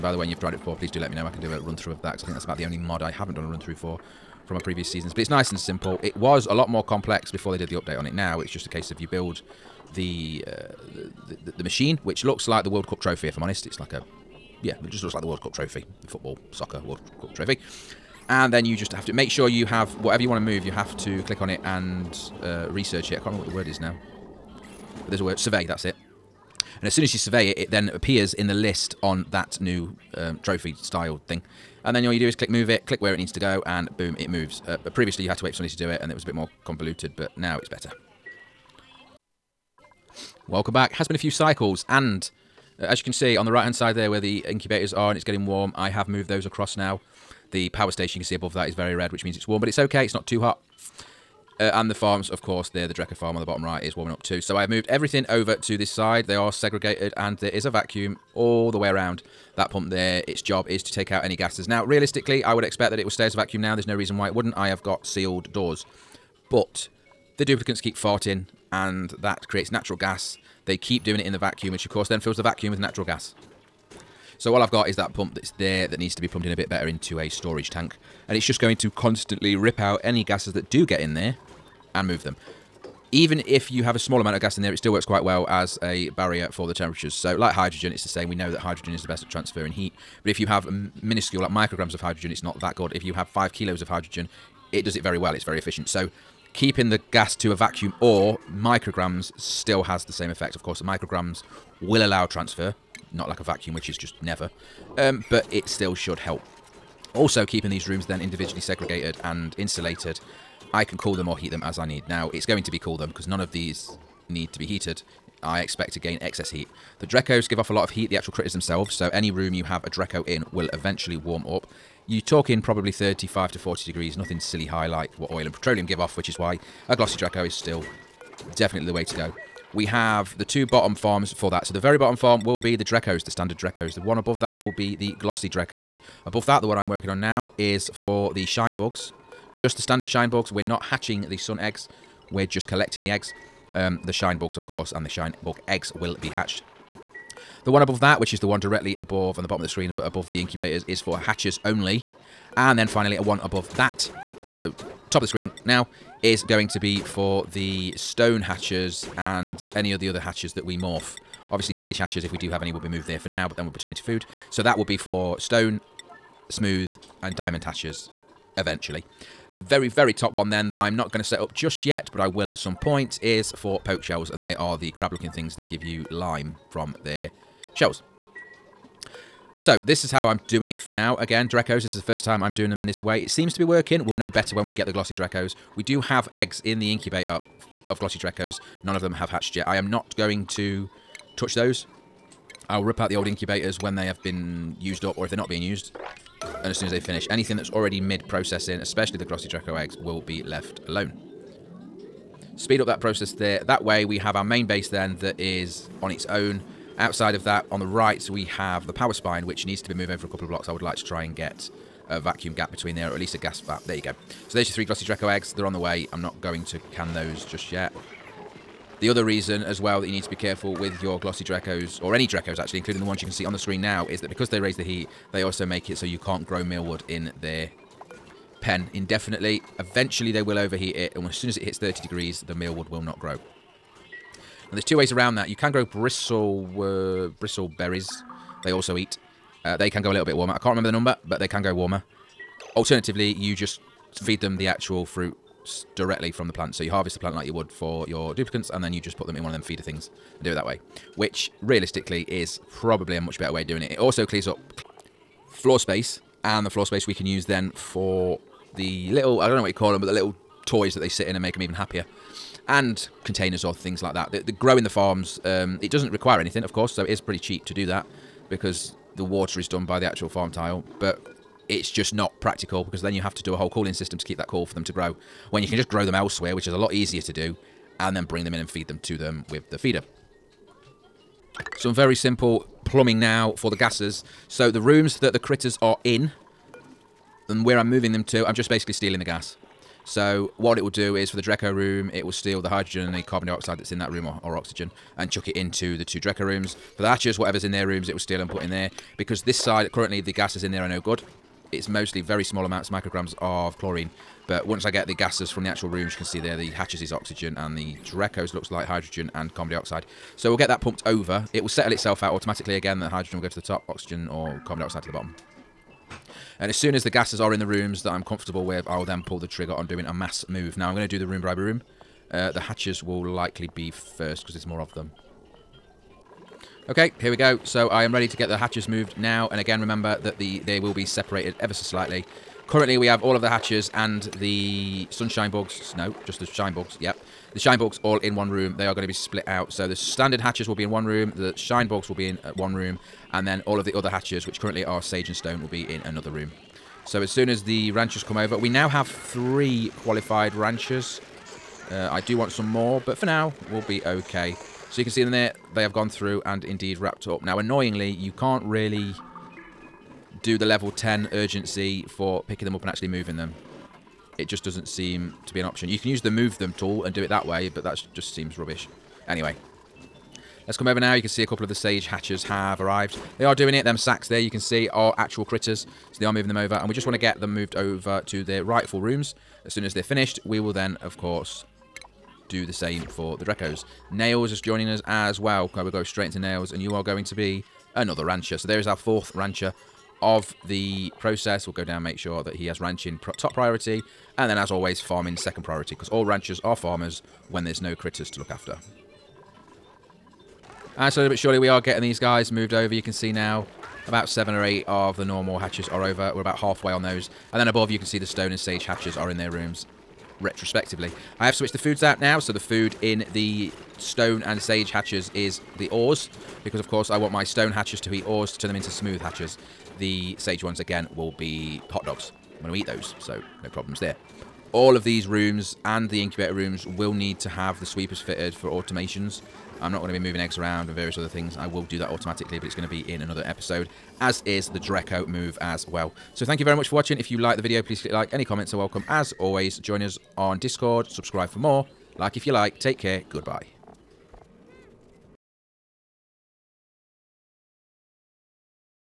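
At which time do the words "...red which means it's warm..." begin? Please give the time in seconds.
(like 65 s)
48 s.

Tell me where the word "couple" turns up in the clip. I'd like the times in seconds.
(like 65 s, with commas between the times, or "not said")
210 s, 371 s.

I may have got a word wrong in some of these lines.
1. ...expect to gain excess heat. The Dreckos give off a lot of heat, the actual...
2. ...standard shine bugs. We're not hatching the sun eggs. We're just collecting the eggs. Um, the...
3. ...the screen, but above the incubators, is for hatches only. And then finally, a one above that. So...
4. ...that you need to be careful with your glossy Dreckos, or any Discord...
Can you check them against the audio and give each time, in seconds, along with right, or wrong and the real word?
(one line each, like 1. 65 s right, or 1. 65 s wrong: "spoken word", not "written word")
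1. 115 s right
2. 139 s right
3. 149 s right
4. 219 s wrong: "Dreckos", not "Discord".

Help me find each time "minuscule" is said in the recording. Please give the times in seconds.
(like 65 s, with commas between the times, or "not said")
90 s.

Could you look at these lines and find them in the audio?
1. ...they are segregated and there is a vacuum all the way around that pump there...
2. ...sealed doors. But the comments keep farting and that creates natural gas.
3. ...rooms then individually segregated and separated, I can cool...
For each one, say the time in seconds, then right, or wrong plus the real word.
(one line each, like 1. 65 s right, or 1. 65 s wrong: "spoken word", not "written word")
1. 56 s right
2. 65 s wrong: "duplicants", not "comments"
3. 107 s wrong: "insulated", not "separated".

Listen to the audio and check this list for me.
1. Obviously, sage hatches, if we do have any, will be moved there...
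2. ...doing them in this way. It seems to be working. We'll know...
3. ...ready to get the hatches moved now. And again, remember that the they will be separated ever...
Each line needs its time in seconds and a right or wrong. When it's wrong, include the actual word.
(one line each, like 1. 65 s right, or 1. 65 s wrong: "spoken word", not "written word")
1. 161 s right
2. 182 s right
3. 328 s right.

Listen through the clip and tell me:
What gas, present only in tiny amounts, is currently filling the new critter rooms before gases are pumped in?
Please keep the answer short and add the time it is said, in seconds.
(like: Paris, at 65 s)
chlorine, at 303 s.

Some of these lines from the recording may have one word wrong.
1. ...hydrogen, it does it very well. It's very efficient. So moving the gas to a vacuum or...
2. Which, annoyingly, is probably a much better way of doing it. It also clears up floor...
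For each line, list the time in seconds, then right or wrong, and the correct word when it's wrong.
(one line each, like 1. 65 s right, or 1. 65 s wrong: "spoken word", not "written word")
1. 93 s wrong: "keeping", not "moving"
2. 251 s wrong: "realistically", not "annoyingly".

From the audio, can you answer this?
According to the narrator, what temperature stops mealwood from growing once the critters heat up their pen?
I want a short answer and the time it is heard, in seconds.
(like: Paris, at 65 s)
30 degrees, at 231 s.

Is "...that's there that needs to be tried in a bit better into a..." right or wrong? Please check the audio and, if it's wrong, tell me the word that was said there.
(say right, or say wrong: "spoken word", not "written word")
wrong: "plumbed", not "tried".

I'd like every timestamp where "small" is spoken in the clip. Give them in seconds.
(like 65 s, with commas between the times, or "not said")
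83 s, 302 s.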